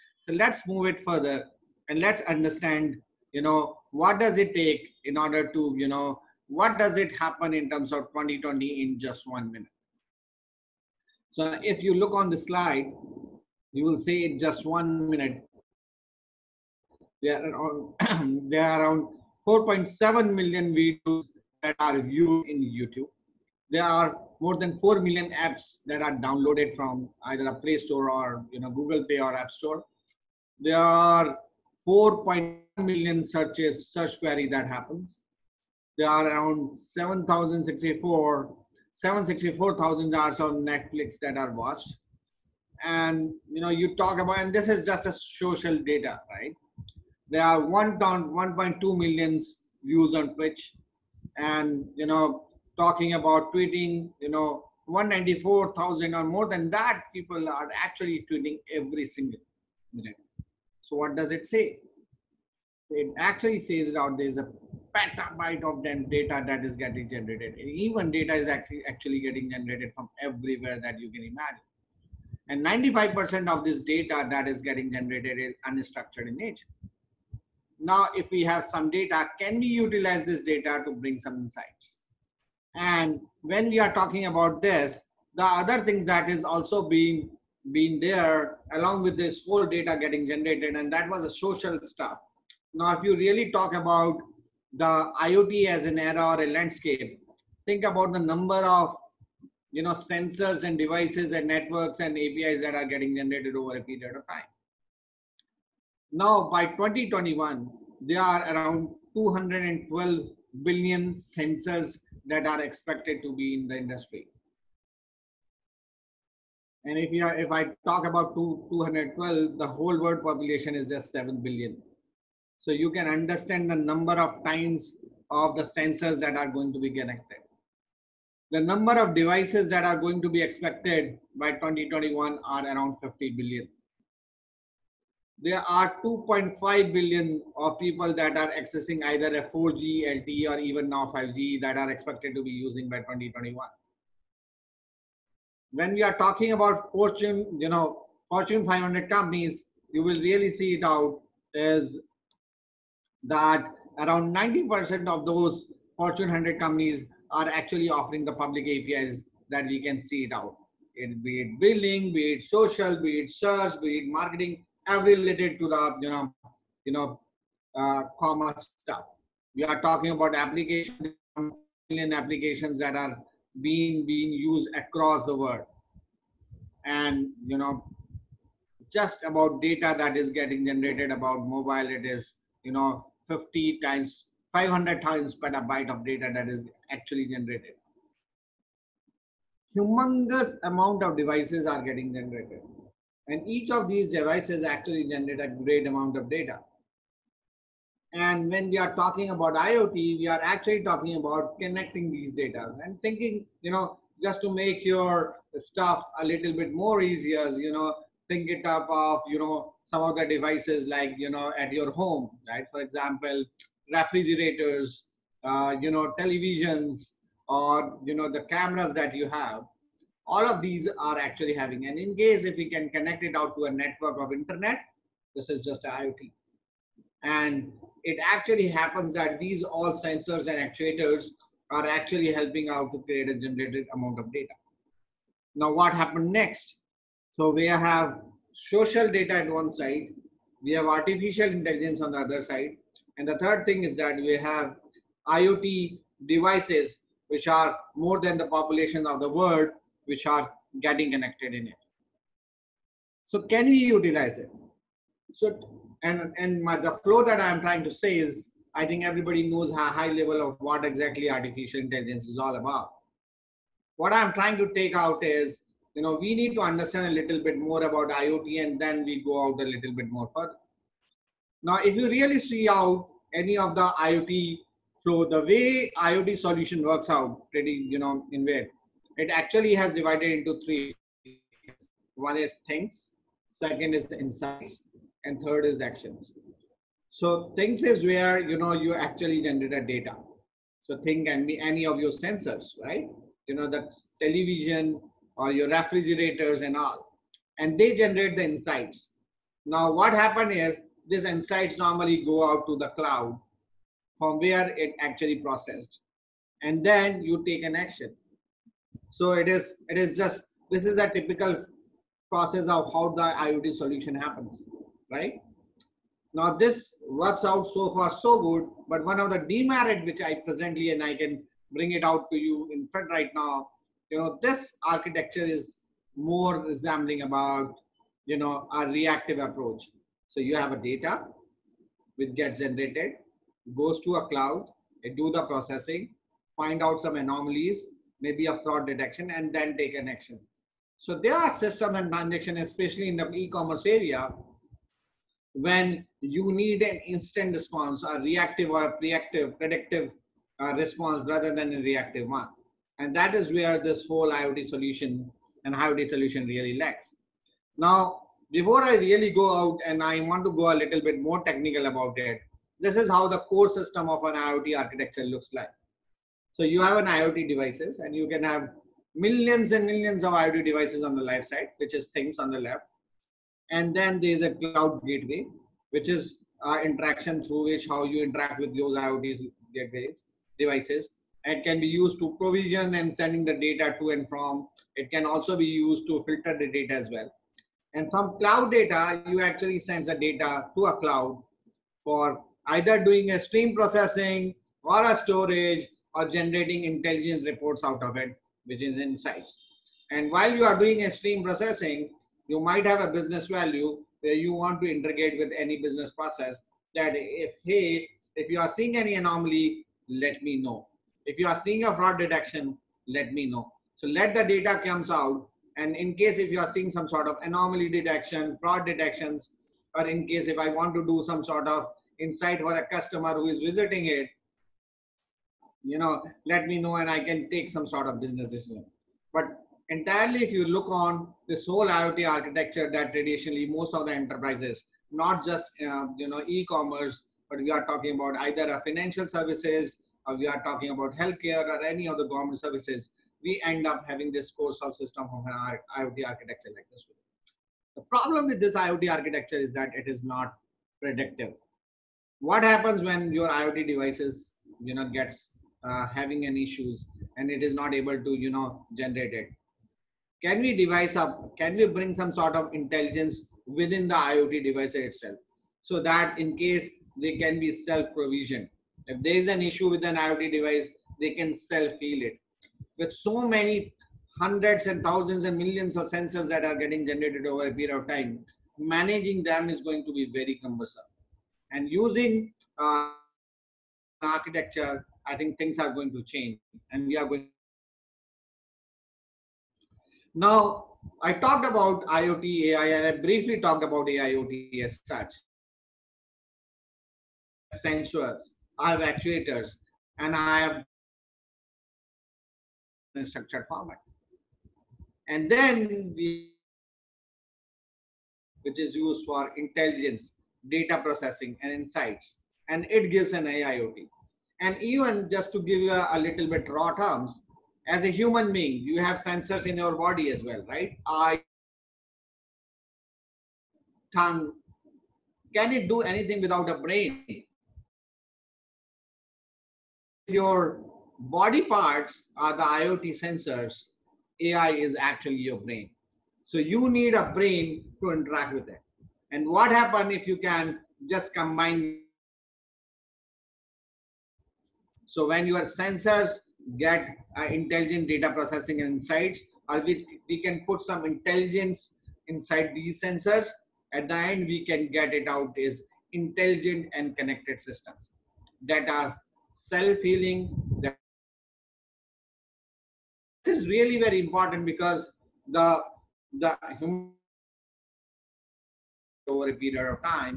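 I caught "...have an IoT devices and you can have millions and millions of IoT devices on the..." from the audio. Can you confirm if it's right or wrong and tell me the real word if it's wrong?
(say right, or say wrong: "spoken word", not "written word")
right.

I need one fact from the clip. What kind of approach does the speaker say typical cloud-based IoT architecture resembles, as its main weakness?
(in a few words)
reactive approach.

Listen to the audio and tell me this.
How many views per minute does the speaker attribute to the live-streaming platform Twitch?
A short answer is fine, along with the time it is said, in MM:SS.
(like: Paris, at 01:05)
1.2 million, at 00:47.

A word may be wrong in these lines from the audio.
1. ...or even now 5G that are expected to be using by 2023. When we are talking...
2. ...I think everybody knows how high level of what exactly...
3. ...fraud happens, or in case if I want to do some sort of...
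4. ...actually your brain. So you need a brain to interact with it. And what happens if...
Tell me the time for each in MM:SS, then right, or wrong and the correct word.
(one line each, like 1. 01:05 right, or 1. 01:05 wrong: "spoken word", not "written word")
1. 02:20 wrong: "2021", not "2023"
2. 04:18 right
3. 06:58 wrong: "detections", not "happens"
4. 08:54 right.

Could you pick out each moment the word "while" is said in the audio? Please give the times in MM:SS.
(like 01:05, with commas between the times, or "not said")
06:40.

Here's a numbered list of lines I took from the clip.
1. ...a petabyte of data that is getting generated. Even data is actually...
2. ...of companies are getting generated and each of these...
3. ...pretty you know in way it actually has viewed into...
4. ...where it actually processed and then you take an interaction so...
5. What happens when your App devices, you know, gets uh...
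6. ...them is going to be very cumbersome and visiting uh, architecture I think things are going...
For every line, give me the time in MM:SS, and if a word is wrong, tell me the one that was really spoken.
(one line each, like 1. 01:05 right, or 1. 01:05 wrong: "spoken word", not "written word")
1. 01:04 right
2. 03:11 wrong: "devices", not "companies"
3. 04:37 wrong: "divided", not "viewed"
4. 05:04 wrong: "action", not "interaction"
5. 07:32 wrong: "IoT", not "App"
6. 07:59 wrong: "using", not "visiting".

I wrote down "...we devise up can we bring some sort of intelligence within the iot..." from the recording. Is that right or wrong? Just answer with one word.
right.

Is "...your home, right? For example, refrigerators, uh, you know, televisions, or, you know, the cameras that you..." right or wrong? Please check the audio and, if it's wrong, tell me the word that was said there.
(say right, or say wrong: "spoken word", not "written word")
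right.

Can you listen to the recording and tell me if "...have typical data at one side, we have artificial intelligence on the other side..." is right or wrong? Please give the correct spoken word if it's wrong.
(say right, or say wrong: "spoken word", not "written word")
wrong: "social", not "typical".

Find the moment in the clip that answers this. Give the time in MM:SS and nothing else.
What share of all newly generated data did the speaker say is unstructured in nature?
01:12.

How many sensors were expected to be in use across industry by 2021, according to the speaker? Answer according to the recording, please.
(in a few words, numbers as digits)
212 billion.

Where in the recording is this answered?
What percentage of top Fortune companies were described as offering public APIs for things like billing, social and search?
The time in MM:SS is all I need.
02:34.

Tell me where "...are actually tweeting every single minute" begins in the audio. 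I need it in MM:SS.
00:57.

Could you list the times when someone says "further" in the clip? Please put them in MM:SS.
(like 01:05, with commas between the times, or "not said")
00:01, 04:30.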